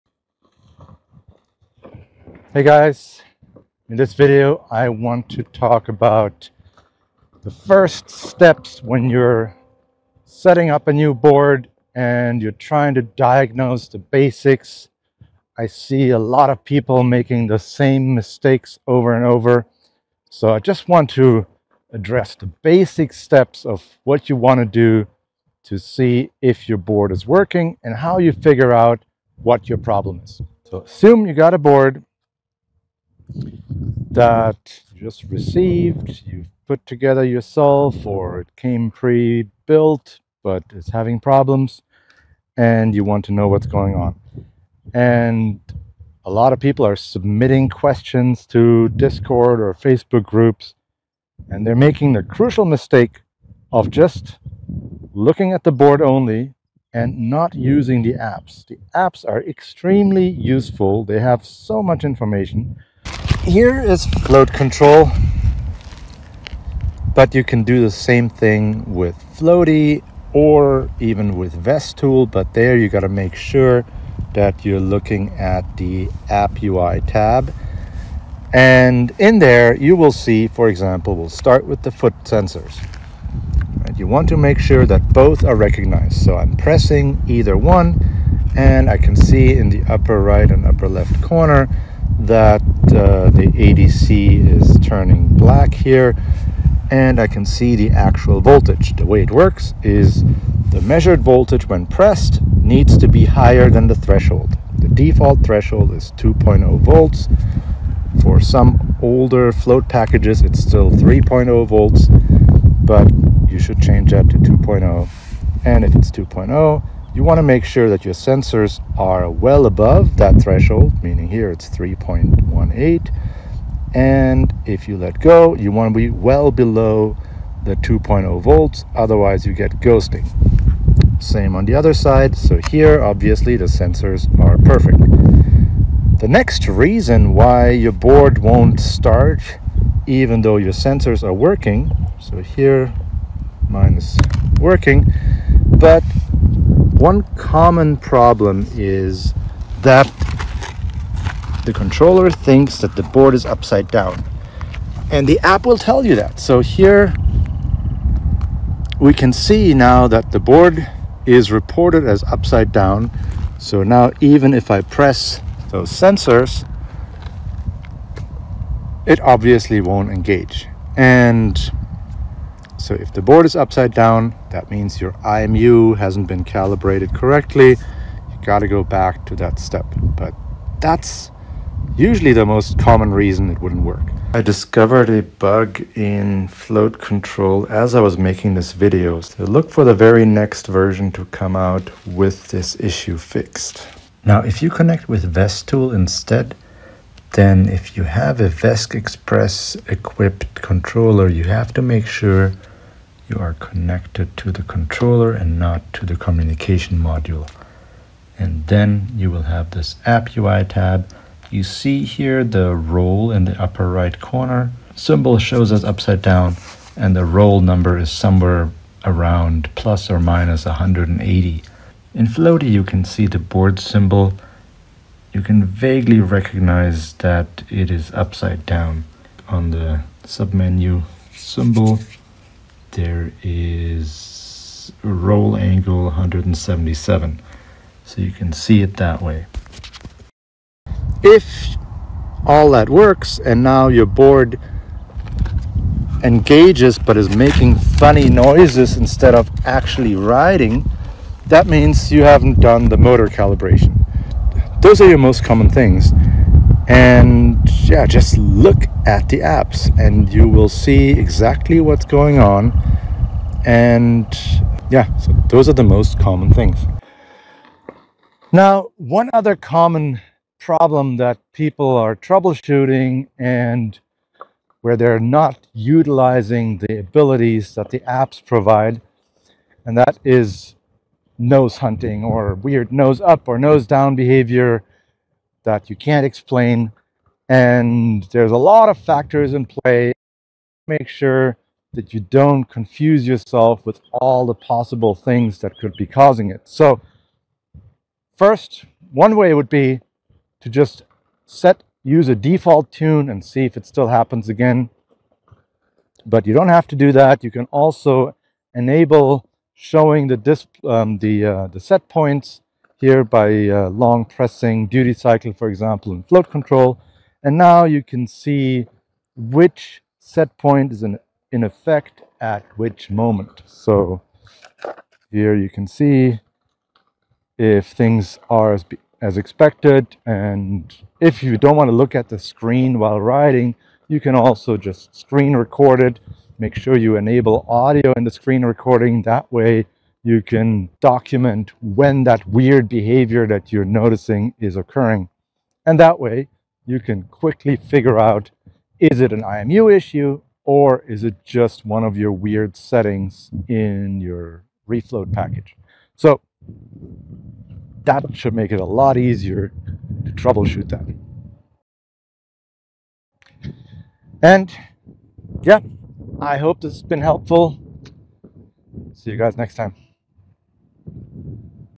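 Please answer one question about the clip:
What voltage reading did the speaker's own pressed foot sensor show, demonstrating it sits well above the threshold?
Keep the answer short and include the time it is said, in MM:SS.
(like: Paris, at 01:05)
3.18, at 02:01.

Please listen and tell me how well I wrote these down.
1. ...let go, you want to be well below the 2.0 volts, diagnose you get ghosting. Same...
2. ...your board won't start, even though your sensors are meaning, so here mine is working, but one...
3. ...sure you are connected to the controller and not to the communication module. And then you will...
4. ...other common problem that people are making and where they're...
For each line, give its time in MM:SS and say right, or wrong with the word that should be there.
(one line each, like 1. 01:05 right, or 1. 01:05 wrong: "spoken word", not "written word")
1. 02:04 wrong: "otherwise", not "diagnose"
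2. 02:17 wrong: "working", not "meaning"
3. 03:22 right
4. 04:29 wrong: "troubleshooting", not "making".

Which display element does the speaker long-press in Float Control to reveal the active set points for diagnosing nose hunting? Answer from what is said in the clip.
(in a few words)
duty cycle.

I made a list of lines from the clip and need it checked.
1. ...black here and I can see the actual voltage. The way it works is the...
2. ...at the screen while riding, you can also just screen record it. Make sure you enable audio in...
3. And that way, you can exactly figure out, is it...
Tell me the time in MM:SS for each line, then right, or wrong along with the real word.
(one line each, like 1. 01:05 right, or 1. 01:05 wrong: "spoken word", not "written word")
1. 01:35 right
2. 05:32 right
3. 05:45 wrong: "quickly", not "exactly".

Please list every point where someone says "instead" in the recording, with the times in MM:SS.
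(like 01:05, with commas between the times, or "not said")
03:15, 04:08.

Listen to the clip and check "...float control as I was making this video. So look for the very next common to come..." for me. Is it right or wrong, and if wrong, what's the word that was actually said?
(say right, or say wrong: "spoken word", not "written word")
wrong: "version", not "common".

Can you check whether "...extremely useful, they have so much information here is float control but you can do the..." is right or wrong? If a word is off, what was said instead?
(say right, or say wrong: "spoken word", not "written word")
right.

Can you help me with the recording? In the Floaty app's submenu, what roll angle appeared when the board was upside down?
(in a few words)
177.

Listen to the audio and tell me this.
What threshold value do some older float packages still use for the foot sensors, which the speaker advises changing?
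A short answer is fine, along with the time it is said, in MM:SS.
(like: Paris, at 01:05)
3.0 volts, at 01:50.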